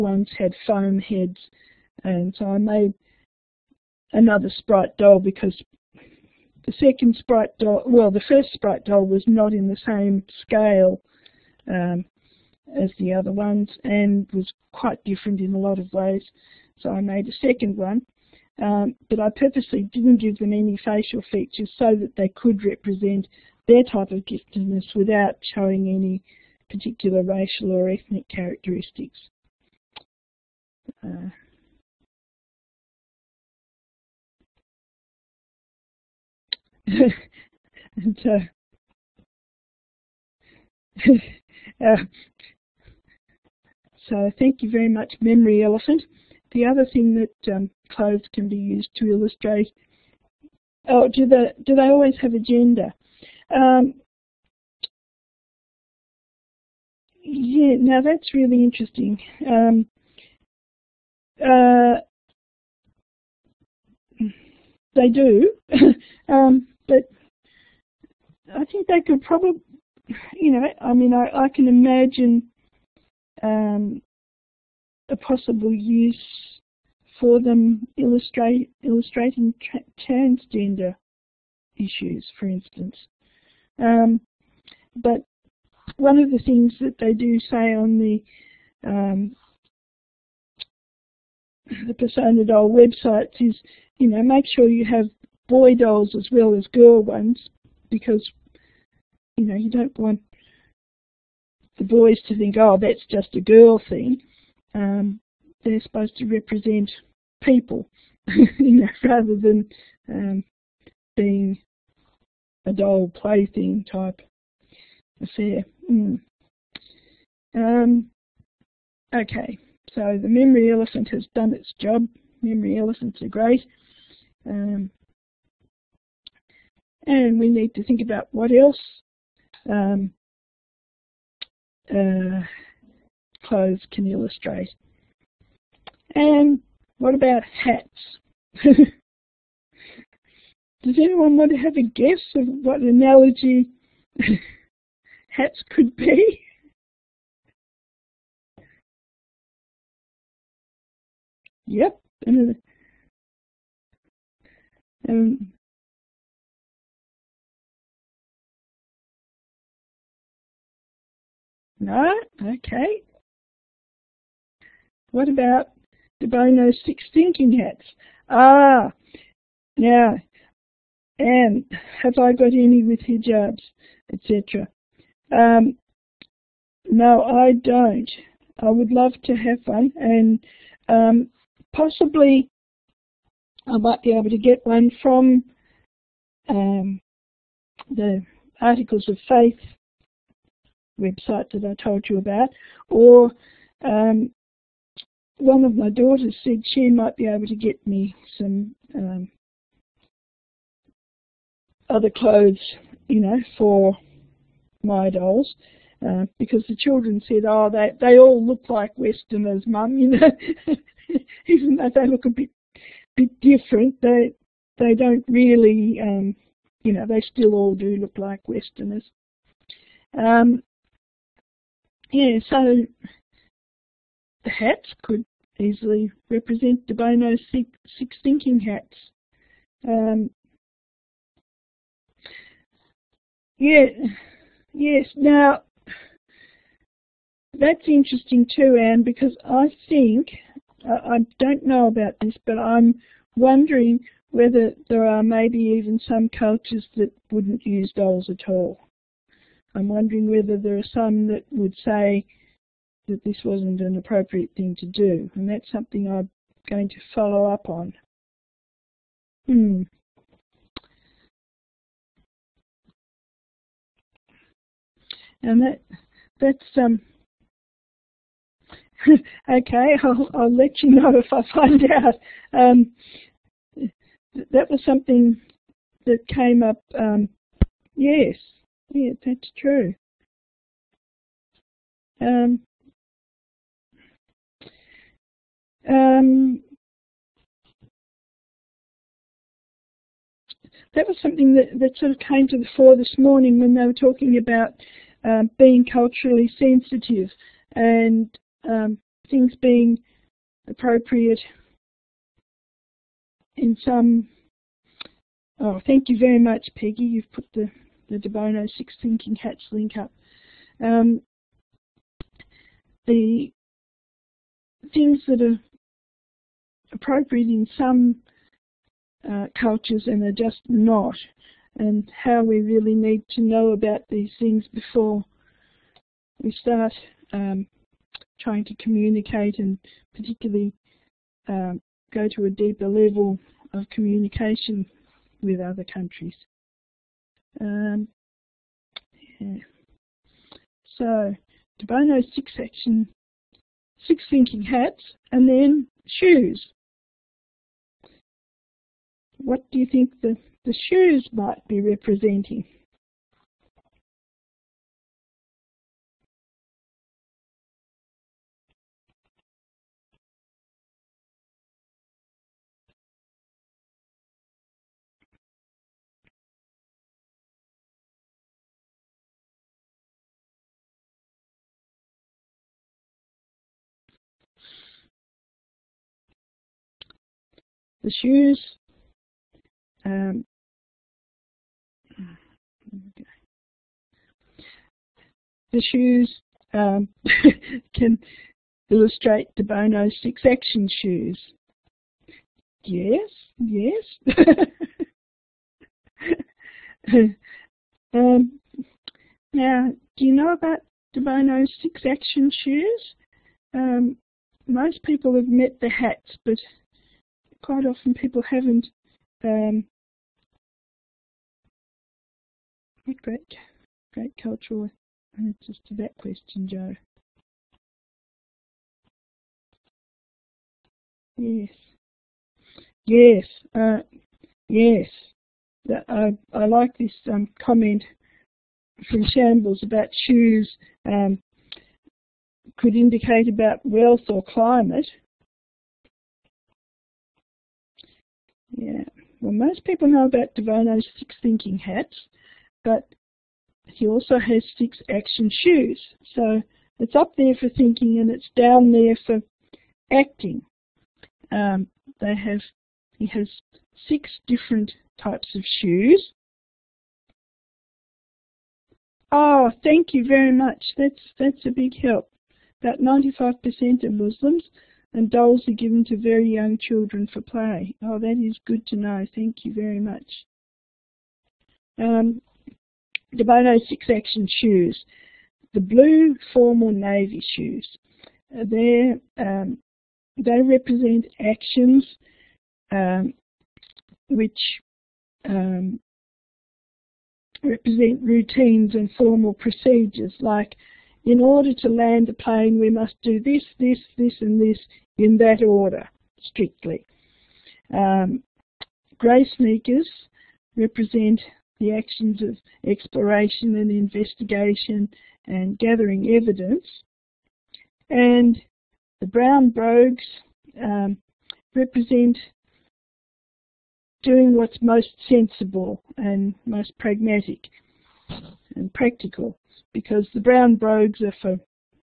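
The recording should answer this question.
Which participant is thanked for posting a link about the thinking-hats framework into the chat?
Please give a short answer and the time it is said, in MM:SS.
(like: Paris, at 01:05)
Peggy, at 05:06.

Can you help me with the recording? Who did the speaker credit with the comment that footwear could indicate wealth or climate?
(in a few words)
Shambles.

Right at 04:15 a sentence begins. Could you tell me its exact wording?
And that's something I'm going to follow up on.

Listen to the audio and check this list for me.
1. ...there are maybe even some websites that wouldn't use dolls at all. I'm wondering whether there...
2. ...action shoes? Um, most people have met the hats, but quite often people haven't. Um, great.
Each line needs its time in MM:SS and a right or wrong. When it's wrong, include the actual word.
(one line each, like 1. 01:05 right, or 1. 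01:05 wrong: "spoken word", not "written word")
1. 04:04 wrong: "cultures", not "websites"
2. 06:42 right.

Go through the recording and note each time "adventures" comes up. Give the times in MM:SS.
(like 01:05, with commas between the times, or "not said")
not said.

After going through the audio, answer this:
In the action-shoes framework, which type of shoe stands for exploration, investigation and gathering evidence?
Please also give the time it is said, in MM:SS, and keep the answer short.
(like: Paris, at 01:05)
grey sneakers, at 08:19.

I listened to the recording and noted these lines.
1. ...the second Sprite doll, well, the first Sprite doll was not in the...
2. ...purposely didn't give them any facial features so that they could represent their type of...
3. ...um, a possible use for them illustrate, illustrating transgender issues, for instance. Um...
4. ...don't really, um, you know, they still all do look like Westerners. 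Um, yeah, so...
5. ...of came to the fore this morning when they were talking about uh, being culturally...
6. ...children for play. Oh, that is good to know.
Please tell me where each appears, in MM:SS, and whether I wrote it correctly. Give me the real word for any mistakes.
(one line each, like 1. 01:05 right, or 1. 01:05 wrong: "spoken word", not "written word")
1. 00:06 right
2. 00:19 right
3. 01:13 right
4. 03:34 right
5. 04:52 right
6. 07:46 right.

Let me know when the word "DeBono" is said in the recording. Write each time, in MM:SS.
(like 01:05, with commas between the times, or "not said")
02:46, 07:53.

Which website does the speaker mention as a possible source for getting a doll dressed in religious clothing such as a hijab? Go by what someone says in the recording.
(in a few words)
Articles of Faith.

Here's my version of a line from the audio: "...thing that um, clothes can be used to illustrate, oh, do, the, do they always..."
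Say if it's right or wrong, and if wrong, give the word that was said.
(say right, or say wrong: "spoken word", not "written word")
right.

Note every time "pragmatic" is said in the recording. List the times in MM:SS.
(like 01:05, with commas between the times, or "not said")
08:36.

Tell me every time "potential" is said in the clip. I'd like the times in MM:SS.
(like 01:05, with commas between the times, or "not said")
not said.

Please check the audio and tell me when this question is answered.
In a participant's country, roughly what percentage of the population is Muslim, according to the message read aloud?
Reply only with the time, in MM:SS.
07:42.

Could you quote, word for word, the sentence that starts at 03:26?
Uh, because the children said, oh, they, they all look like Westerners, Mum, you know.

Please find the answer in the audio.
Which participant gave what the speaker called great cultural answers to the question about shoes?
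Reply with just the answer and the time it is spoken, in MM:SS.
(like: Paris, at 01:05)
Jo, at 06:56.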